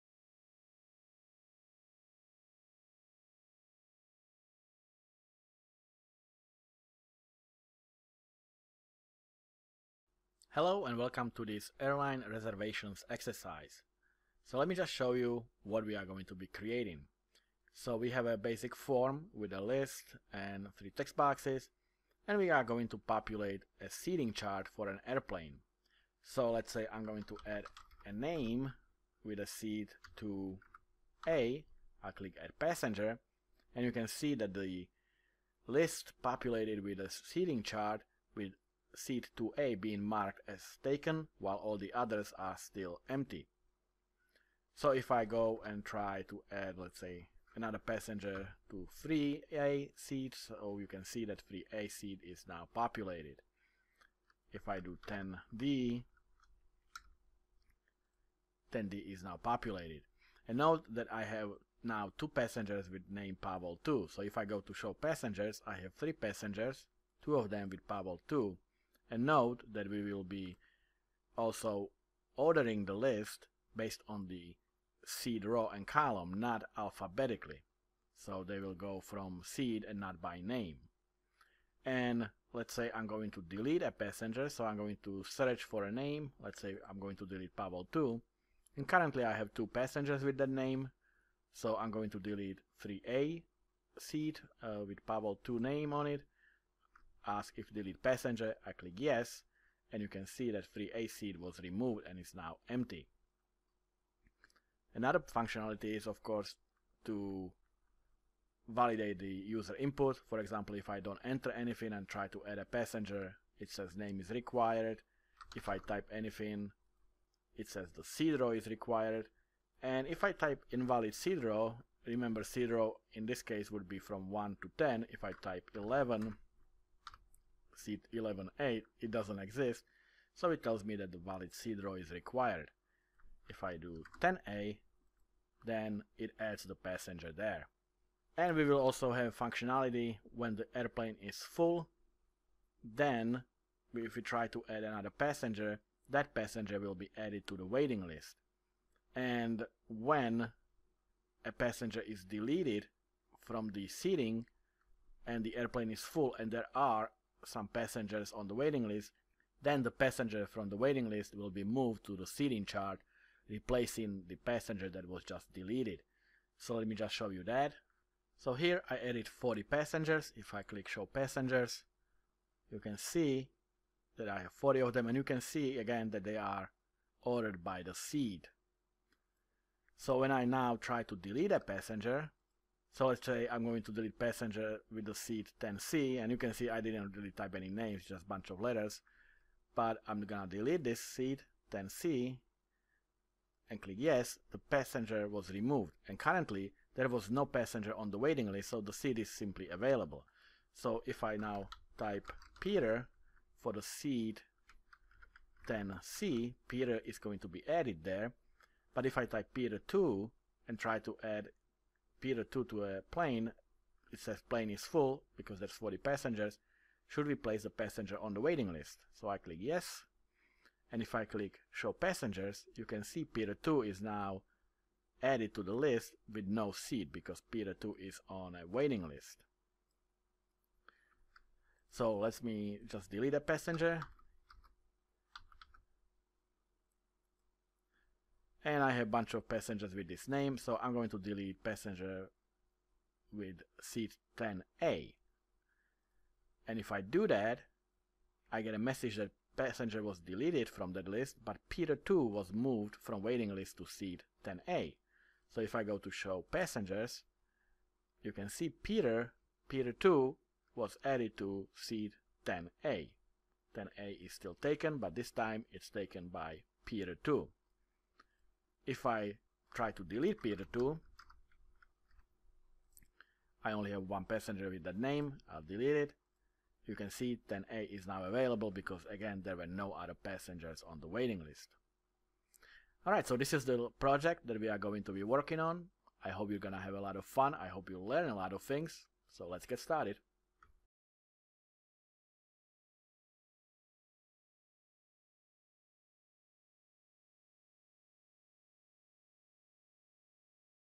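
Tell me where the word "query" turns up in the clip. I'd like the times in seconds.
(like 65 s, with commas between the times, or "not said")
not said.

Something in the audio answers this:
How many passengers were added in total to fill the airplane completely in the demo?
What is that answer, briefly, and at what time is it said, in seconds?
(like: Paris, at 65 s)
40, at 168 s.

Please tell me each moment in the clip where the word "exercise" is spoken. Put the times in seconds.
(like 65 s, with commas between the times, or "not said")
13 s.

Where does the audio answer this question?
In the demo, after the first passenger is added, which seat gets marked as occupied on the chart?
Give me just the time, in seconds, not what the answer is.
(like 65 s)
39 s.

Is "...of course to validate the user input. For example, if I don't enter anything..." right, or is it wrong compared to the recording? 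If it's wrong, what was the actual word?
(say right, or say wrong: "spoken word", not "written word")
right.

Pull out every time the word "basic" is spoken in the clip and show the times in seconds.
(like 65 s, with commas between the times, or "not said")
18 s.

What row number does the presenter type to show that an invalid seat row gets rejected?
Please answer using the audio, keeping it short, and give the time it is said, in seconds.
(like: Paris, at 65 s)
11, at 125 s.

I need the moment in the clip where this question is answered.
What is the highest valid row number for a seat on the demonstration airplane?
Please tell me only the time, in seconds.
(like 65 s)
123 s.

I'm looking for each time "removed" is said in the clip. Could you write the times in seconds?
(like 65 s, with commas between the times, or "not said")
101 s, 195 s.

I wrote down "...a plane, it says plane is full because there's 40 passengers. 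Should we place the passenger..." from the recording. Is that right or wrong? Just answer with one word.
right.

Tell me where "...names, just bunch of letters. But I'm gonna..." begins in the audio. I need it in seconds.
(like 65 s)
187 s.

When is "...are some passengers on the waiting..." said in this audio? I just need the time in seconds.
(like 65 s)
156 s.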